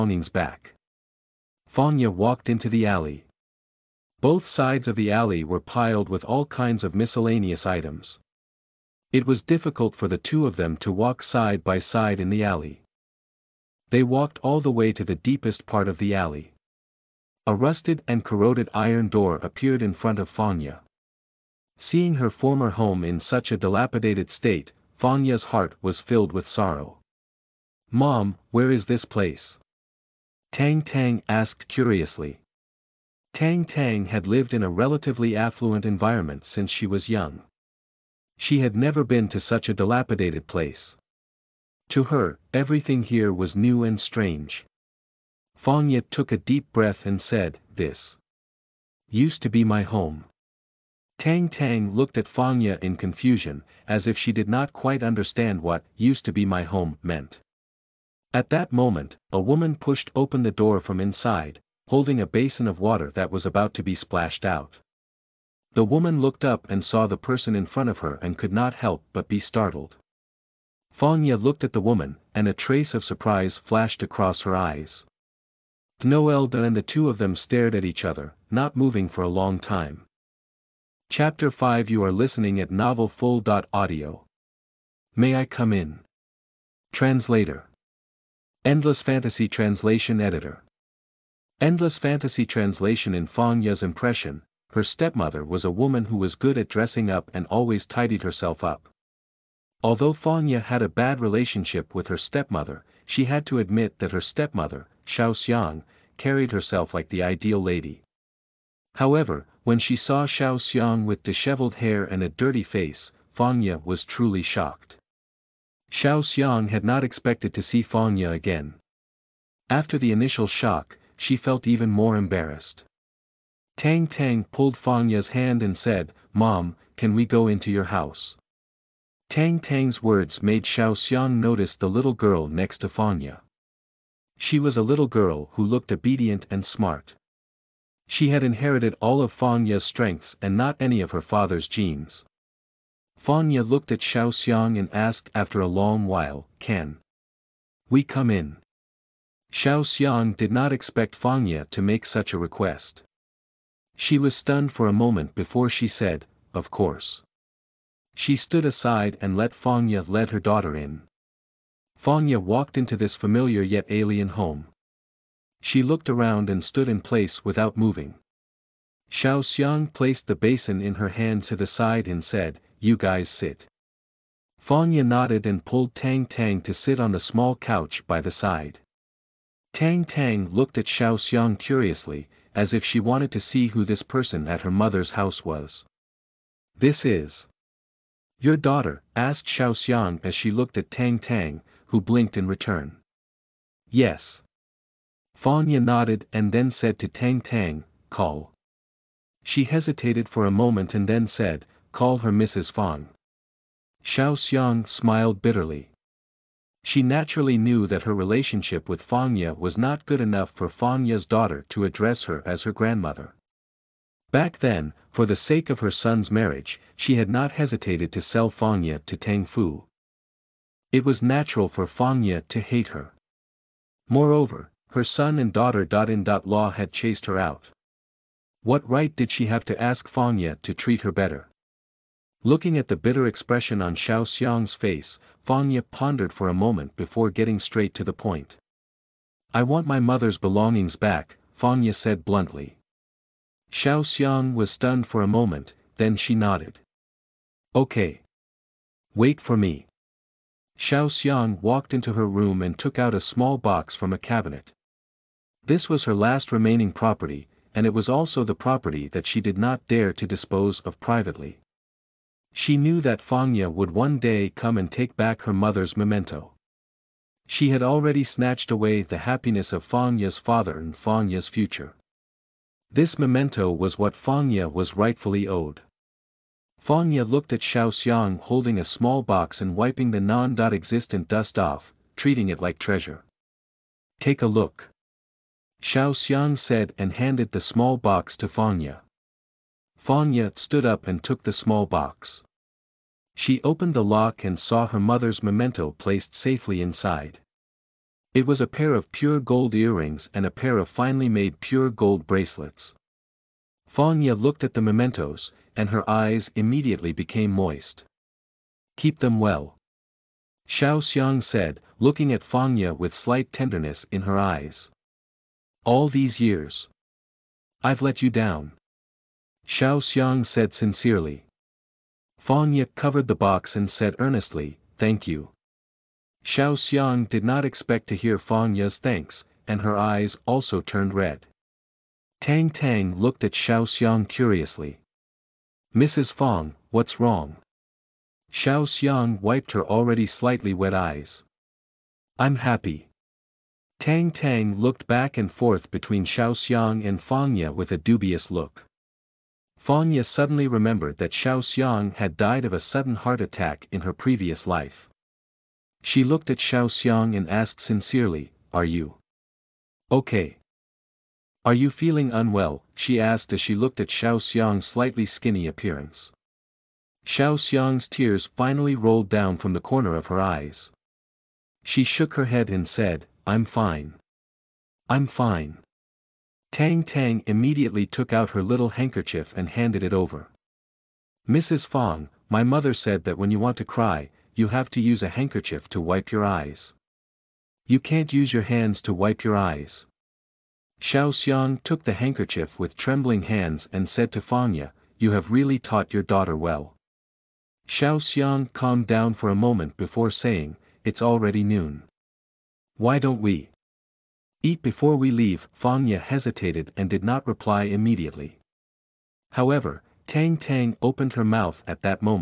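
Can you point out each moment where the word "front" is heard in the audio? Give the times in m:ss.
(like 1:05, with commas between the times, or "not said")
0:19, 1:07.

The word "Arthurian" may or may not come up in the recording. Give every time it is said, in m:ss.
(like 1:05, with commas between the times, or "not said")
not said.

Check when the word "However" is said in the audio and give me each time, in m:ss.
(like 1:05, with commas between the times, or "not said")
1:48, 6:49.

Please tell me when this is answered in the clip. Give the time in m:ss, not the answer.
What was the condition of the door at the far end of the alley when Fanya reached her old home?
0:17.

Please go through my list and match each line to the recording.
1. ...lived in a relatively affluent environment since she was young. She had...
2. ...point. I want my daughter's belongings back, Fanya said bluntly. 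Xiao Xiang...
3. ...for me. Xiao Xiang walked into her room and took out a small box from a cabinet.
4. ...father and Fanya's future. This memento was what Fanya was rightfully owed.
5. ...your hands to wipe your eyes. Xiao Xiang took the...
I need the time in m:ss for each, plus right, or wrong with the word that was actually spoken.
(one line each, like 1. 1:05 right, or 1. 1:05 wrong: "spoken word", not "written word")
1. 0:34 right
2. 3:58 wrong: "mother", not "daughter"
3. 4:09 right
4. 4:30 right
5. 6:28 right.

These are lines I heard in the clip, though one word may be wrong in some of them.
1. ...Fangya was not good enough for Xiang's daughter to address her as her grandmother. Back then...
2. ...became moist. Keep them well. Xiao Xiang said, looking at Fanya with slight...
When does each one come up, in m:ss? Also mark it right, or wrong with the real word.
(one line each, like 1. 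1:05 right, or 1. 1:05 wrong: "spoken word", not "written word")
1. 3:29 wrong: "Fangya", not "Xiang"
2. 5:07 right.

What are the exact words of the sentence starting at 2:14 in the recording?
She was a little girl who looked obedient and smart.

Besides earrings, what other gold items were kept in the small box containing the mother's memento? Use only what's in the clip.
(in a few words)
Pure gold bracelets.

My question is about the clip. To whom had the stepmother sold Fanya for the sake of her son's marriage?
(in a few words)
Tang Fu.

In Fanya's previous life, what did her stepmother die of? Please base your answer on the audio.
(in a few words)
Sudden heart attack.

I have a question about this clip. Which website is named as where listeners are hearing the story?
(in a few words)
novelfull.audio.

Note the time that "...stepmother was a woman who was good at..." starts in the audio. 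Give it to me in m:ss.
1:34.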